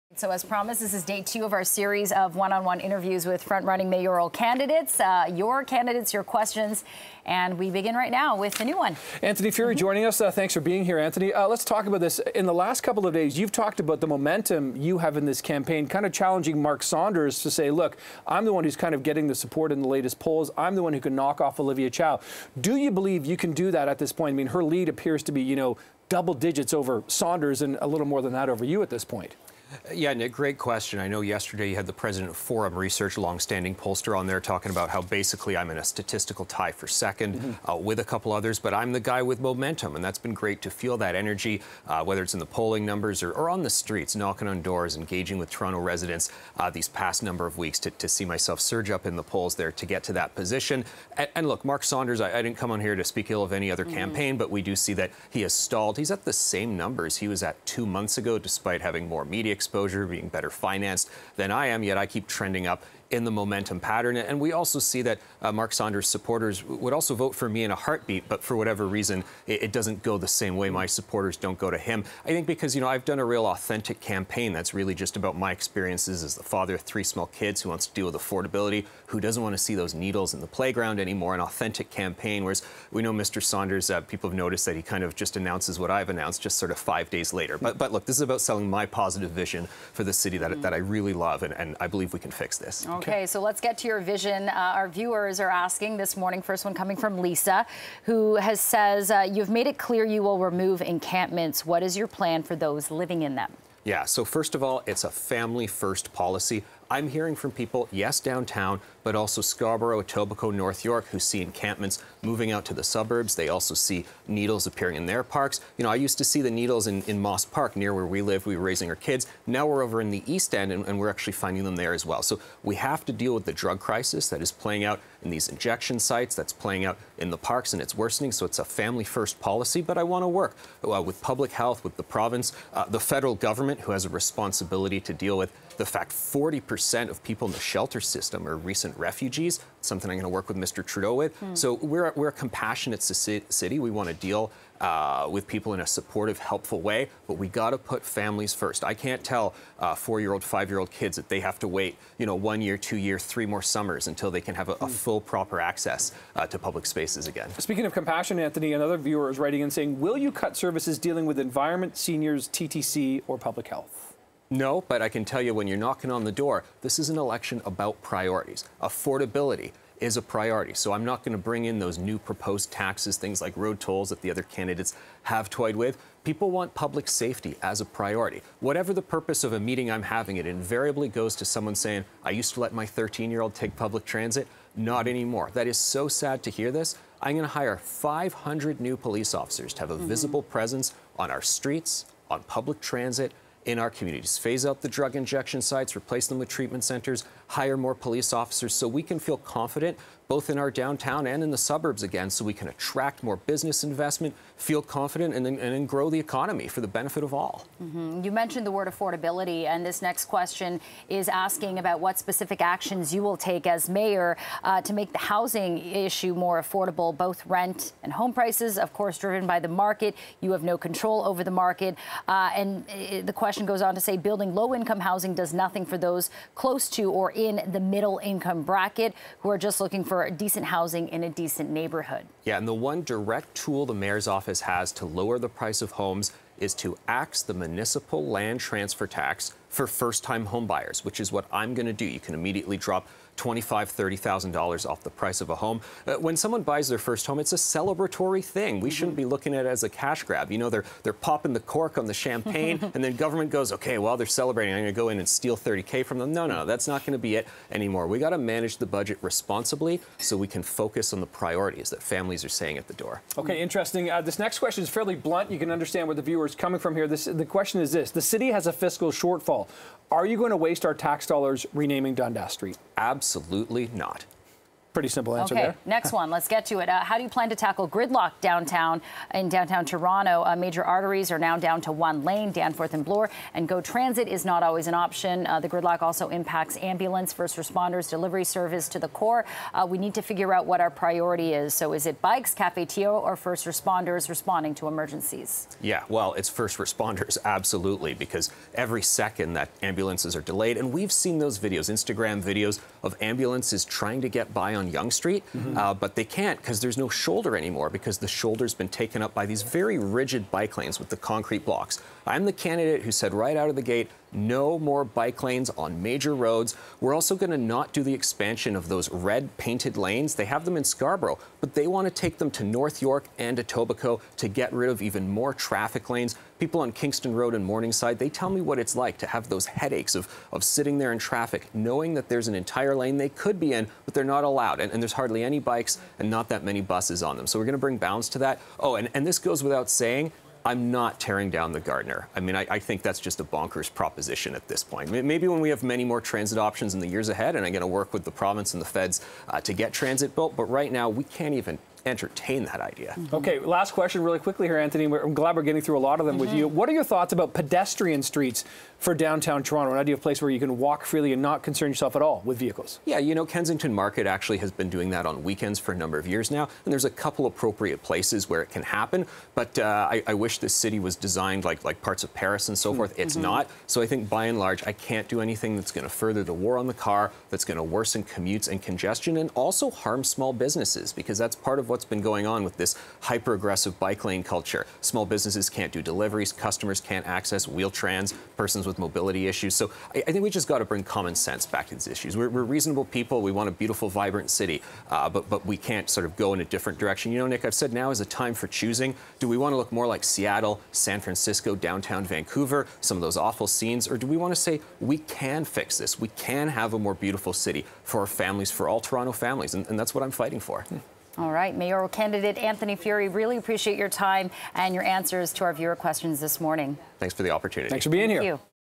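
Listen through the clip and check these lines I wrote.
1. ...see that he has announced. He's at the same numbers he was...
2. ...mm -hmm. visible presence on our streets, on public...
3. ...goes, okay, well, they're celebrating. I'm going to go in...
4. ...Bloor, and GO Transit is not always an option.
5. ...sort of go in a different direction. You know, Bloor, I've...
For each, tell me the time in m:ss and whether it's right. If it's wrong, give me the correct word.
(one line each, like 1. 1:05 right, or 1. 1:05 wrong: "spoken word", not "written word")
1. 0:54 wrong: "stalled", not "announced"
2. 3:09 right
3. 4:13 right
4. 4:43 right
5. 6:36 wrong: "Nick", not "Bloor".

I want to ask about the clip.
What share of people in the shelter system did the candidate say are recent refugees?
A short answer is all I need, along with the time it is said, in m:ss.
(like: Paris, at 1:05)
40%, at 2:16.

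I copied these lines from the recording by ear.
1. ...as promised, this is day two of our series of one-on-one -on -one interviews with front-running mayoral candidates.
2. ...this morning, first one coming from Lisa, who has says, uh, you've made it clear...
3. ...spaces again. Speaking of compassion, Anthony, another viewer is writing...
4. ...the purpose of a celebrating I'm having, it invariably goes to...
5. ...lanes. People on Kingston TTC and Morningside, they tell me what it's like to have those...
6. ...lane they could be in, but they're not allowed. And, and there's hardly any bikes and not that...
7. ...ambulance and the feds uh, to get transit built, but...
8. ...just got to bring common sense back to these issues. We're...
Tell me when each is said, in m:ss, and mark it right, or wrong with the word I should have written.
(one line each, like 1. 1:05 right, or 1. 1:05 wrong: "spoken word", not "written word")
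1. 0:00 right
2. 1:35 right
3. 2:36 right
4. 2:58 wrong: "meeting", not "celebrating"
5. 5:26 wrong: "Road", not "TTC"
6. 5:32 right
7. 5:48 wrong: "province", not "ambulance"
8. 6:30 right.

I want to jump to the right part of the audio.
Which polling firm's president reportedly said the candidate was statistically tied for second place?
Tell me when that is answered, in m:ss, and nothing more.
0:32.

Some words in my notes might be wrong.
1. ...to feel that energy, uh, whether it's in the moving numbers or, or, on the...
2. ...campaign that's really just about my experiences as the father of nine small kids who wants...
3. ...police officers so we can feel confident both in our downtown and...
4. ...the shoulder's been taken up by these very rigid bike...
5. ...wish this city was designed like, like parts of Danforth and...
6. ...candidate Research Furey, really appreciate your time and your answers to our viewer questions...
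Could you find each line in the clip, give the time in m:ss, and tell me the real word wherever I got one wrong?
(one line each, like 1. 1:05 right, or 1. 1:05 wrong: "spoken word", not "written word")
1. 0:40 wrong: "polling", not "moving"
2. 1:14 wrong: "three", not "nine"
3. 3:17 right
4. 5:08 right
5. 6:10 wrong: "Paris", not "Danforth"
6. 6:52 wrong: "Anthony", not "Research".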